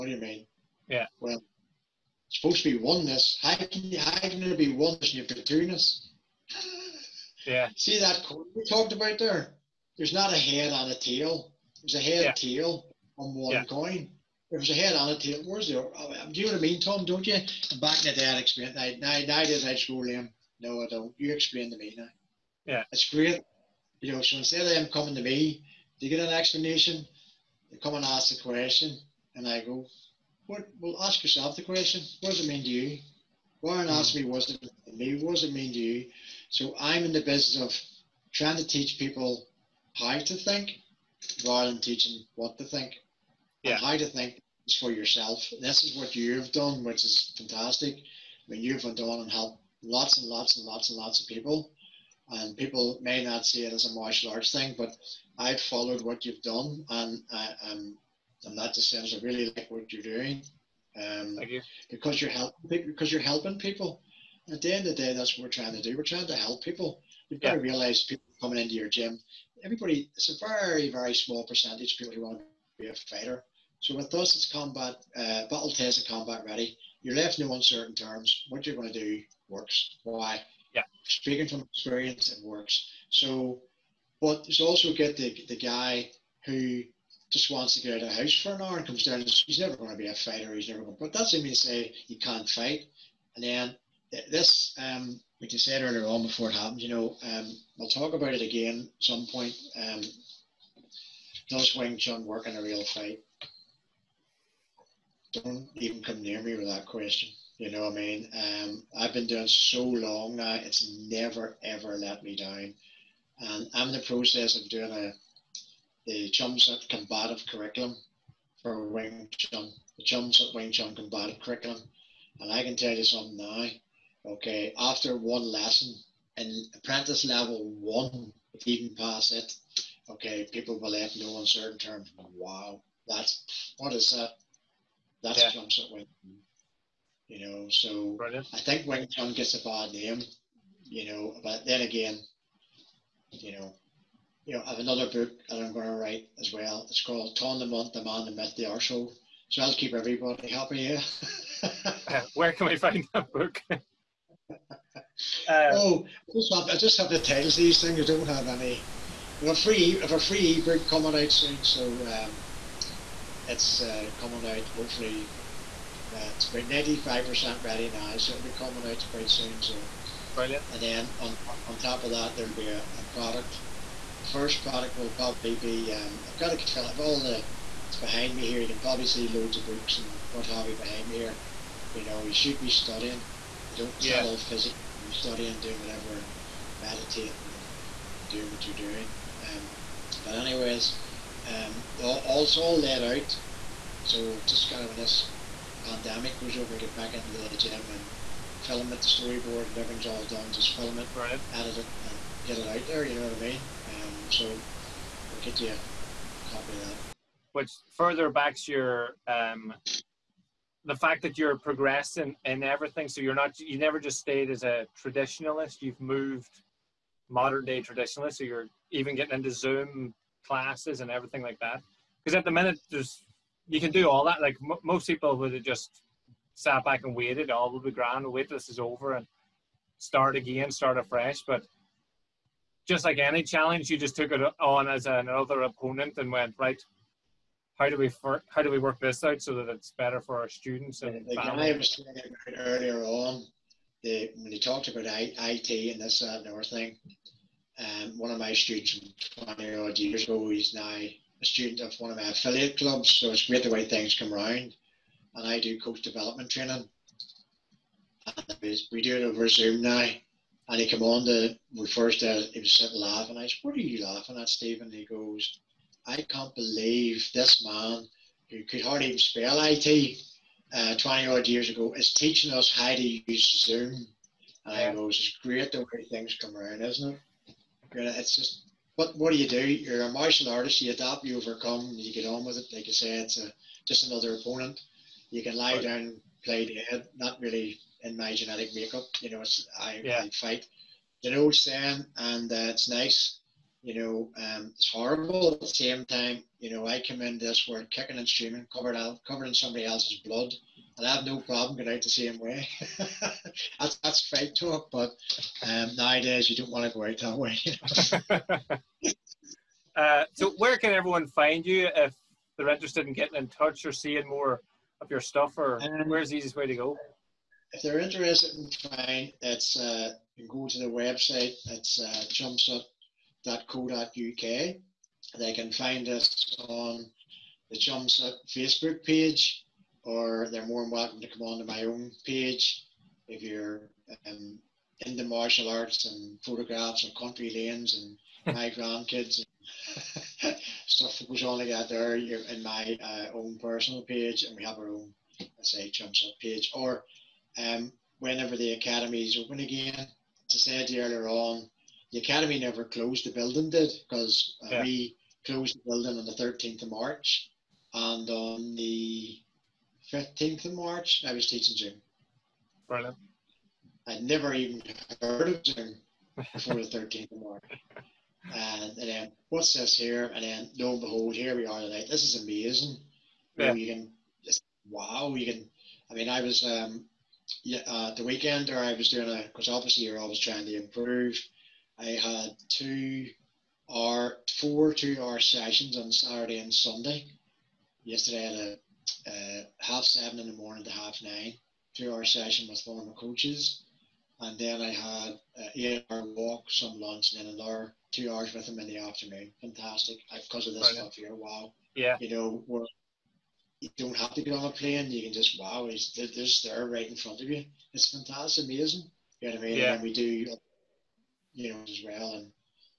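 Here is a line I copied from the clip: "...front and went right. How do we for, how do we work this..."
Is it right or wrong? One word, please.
wrong.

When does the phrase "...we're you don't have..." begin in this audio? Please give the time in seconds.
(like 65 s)
402 s.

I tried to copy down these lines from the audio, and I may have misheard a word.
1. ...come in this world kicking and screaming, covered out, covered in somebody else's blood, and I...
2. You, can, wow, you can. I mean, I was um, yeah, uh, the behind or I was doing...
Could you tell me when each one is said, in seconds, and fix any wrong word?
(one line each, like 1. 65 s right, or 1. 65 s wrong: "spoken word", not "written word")
1. 297 s right
2. 373 s wrong: "weekend", not "behind".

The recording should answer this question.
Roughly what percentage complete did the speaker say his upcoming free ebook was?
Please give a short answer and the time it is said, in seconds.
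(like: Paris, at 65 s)
95%, at 166 s.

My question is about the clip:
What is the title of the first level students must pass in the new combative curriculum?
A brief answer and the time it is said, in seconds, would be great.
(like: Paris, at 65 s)
Apprentice level one, at 126 s.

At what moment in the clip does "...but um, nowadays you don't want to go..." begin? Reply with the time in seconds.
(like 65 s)
304 s.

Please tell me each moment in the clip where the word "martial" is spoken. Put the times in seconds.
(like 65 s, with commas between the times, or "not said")
53 s, 280 s, 335 s.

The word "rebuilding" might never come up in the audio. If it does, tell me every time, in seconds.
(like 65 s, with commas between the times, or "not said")
not said.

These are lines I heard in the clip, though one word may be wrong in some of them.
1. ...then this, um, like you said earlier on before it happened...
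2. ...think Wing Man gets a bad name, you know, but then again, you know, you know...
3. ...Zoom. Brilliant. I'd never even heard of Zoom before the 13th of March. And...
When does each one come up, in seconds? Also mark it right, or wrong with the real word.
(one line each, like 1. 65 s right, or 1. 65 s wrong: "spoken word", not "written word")
1. 93 s right
2. 138 s wrong: "Chun", not "Man"
3. 361 s right.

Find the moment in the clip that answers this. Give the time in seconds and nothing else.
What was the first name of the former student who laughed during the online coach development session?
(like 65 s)
264 s.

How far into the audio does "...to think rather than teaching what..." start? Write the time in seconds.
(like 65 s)
40 s.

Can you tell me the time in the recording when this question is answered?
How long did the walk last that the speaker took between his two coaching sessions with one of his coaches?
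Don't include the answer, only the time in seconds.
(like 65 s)
395 s.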